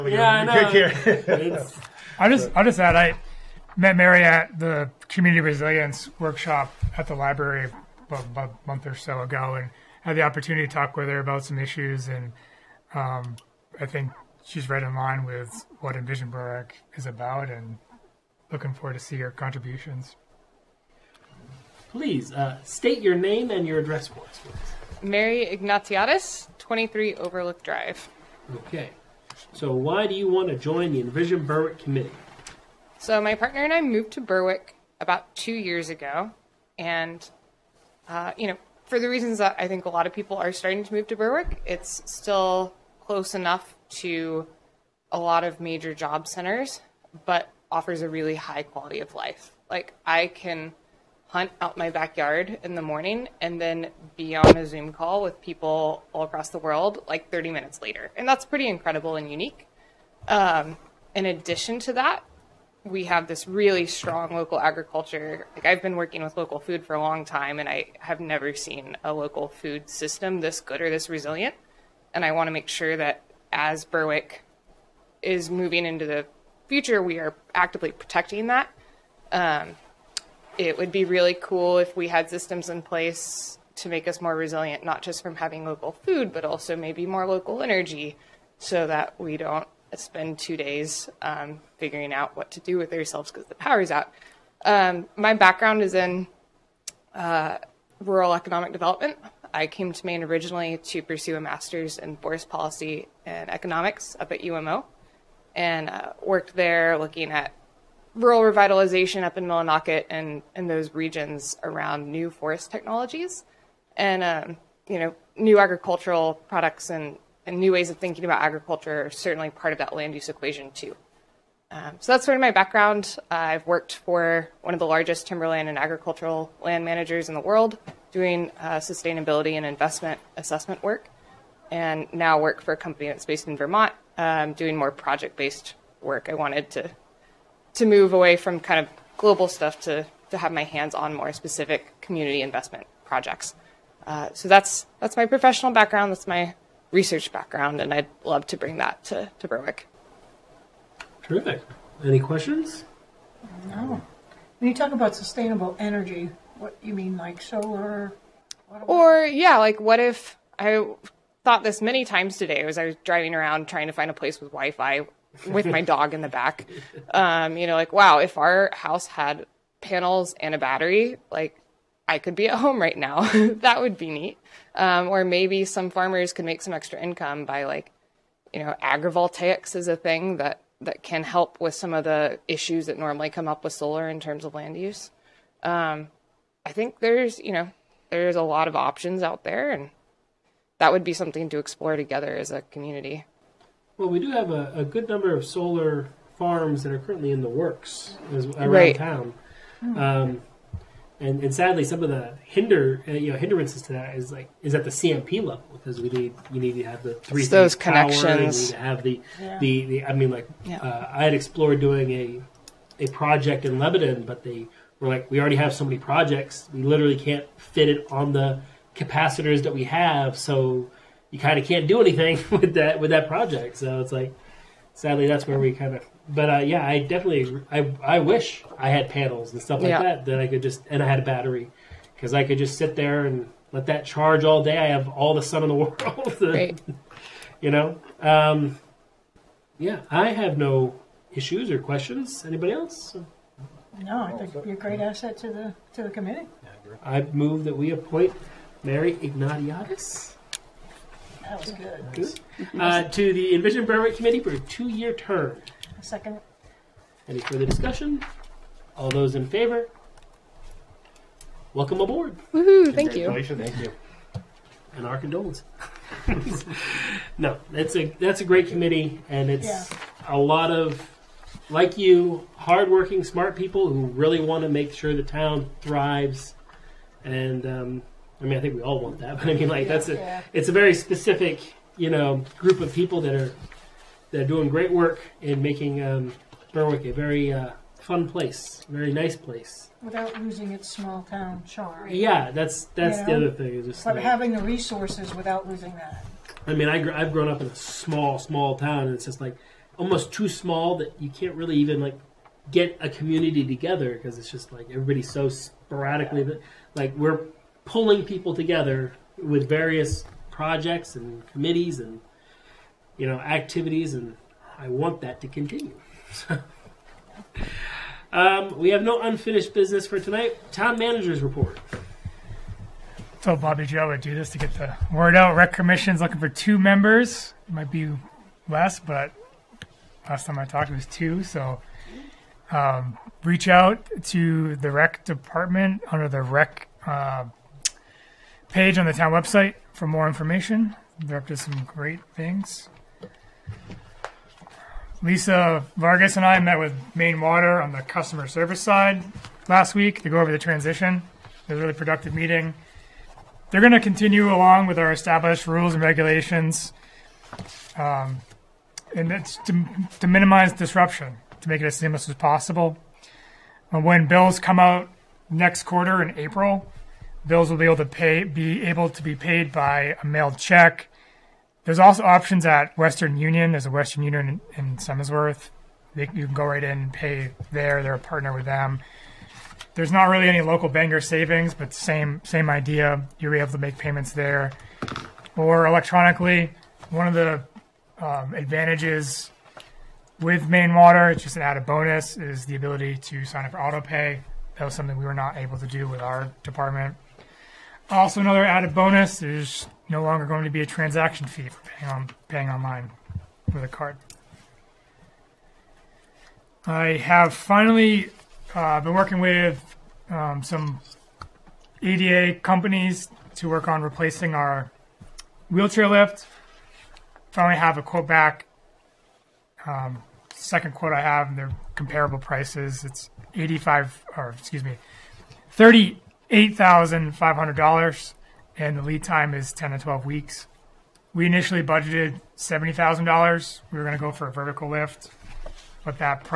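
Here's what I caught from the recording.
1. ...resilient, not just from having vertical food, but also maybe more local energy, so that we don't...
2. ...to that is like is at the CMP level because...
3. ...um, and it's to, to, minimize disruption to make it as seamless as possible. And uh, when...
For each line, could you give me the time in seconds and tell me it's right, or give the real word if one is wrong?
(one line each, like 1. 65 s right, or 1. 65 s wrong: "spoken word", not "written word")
1. 84 s wrong: "local", not "vertical"
2. 203 s right
3. 357 s right.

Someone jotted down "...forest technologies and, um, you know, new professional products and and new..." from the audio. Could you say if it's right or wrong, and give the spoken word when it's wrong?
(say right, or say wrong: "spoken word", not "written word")
wrong: "agricultural", not "professional".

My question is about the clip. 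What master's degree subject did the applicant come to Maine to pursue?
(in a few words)
forest policy and economics.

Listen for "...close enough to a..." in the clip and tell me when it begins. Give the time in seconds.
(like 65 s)
43 s.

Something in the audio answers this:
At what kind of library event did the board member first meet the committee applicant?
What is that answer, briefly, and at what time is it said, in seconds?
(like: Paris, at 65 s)
community resilience workshop, at 5 s.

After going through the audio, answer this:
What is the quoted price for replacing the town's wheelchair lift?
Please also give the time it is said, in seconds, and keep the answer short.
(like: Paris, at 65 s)
$38,500, at 425 s.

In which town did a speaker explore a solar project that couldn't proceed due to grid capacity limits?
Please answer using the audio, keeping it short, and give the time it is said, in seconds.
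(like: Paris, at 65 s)
Lebanon, at 213 s.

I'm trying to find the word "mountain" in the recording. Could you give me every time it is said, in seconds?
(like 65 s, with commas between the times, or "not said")
not said.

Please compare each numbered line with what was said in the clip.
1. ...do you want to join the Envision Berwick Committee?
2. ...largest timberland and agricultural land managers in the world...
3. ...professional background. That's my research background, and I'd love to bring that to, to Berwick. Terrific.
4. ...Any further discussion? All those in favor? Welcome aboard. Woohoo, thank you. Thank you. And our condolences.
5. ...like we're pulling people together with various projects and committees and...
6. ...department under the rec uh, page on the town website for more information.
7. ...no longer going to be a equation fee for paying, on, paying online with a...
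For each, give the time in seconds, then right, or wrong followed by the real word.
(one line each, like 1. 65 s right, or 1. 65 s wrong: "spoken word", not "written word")
1. 30 s right
2. 124 s right
3. 145 s right
4. 257 s right
5. 306 s right
6. 335 s right
7. 400 s wrong: "transaction", not "equation".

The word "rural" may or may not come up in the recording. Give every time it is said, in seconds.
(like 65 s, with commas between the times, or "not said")
97 s, 108 s.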